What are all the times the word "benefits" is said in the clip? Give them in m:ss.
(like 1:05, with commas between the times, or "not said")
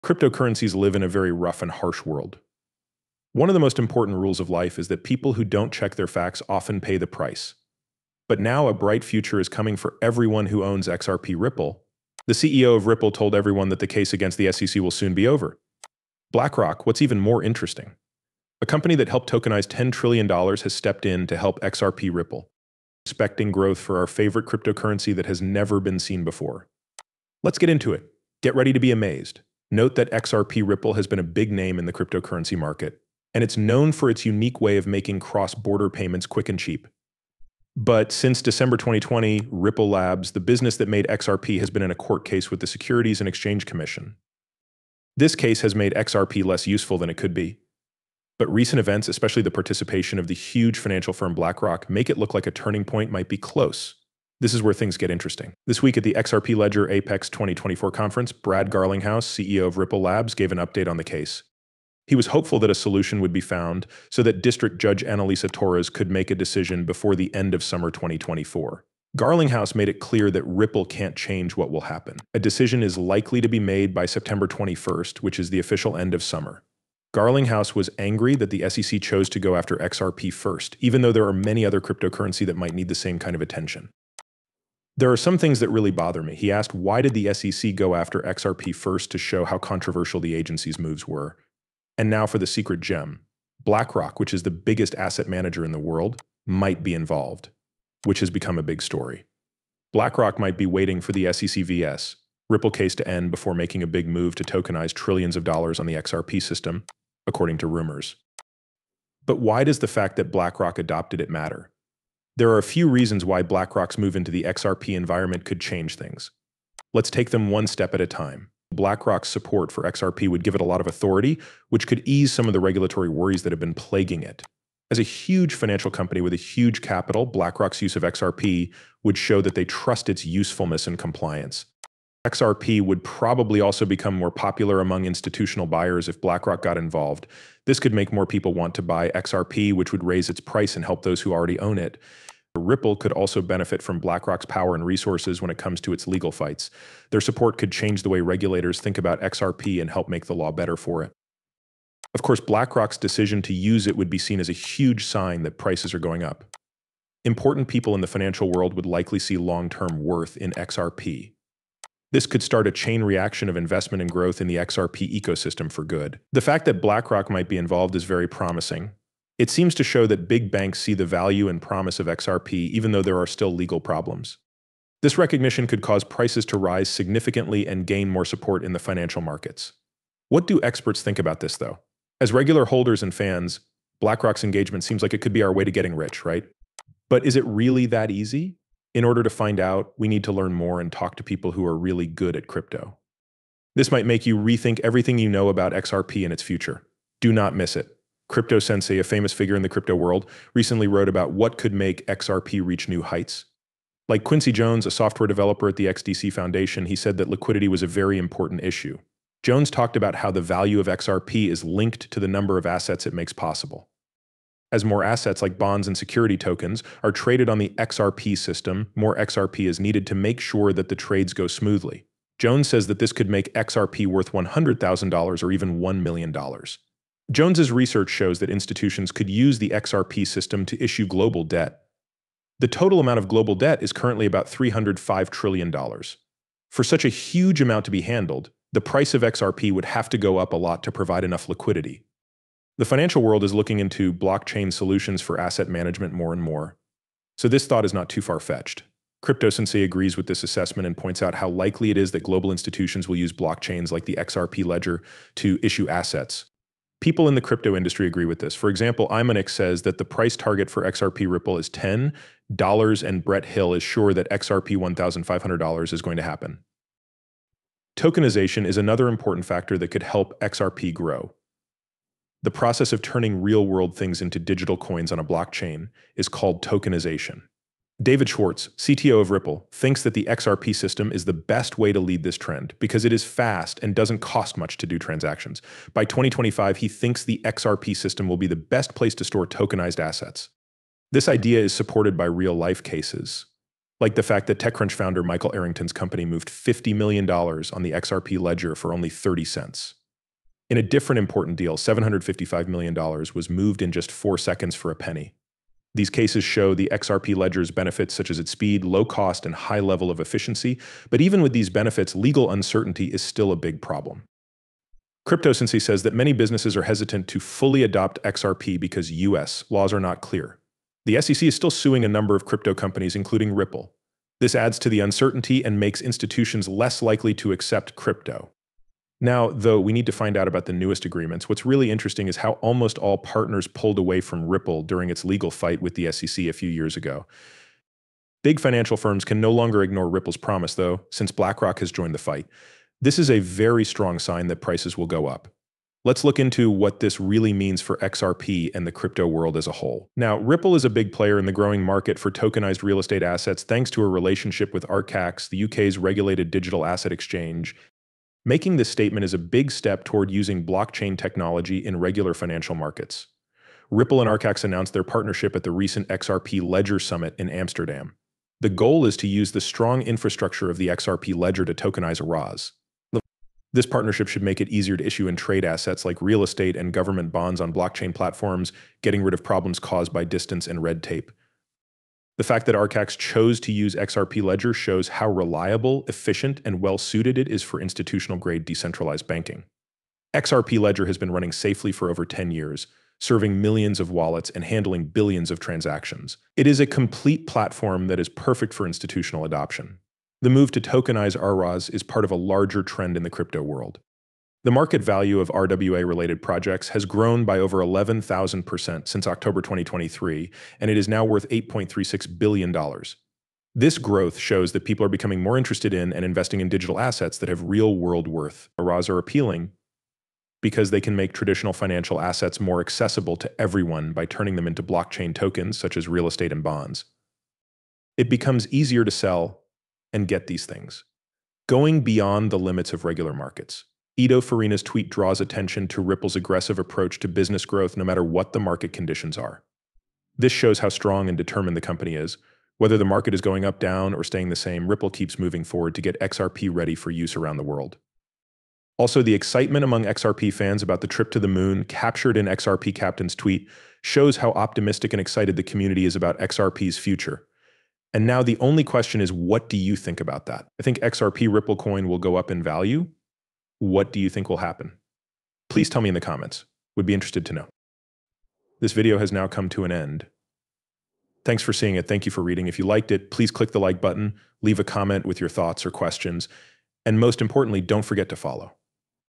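2:23, 5:07, 5:11.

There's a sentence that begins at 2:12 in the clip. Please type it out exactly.
XRP would probably also become more popular among institutional buyers if BlackRock got involved.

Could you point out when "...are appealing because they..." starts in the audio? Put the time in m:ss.
6:59.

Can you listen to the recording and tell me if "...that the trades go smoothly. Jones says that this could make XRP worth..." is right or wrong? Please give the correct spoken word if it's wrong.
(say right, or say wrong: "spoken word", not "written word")
right.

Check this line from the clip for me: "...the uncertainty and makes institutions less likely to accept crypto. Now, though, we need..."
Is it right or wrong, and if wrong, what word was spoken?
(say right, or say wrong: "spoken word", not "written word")
right.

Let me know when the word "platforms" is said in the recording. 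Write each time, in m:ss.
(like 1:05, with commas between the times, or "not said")
6:18, 6:37.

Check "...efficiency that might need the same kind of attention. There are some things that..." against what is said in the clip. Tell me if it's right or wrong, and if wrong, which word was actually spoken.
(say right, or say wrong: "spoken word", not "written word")
wrong: "cryptocurrency", not "efficiency".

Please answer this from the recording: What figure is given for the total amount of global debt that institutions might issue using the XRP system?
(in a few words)
$305 trillion.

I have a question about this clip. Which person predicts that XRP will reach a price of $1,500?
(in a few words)
Brett Hill.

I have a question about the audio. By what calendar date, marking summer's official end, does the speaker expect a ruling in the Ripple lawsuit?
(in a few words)
September 21.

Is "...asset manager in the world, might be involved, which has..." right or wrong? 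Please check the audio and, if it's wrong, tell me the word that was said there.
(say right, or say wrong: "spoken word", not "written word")
right.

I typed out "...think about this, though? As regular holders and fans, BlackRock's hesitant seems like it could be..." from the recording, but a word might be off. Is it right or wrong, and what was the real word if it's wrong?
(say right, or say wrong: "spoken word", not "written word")
wrong: "engagement", not "hesitant".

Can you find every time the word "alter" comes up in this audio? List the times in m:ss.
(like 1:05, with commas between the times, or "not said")
not said.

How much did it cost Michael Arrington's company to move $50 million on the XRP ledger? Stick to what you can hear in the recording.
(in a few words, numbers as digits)
30 cents.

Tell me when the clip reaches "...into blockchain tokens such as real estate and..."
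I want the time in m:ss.
7:04.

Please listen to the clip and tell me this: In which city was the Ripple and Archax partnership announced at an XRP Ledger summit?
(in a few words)
Amsterdam.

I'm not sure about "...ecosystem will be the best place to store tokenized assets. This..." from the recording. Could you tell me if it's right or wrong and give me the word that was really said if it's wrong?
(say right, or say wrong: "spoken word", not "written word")
wrong: "system", not "ecosystem".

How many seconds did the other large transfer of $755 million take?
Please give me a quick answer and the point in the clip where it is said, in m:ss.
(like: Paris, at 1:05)
4, at 5:04.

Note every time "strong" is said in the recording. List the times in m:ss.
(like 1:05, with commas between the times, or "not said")
5:43, 6:09, 7:20.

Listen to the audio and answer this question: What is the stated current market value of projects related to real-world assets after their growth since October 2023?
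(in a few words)
$8.36 billion.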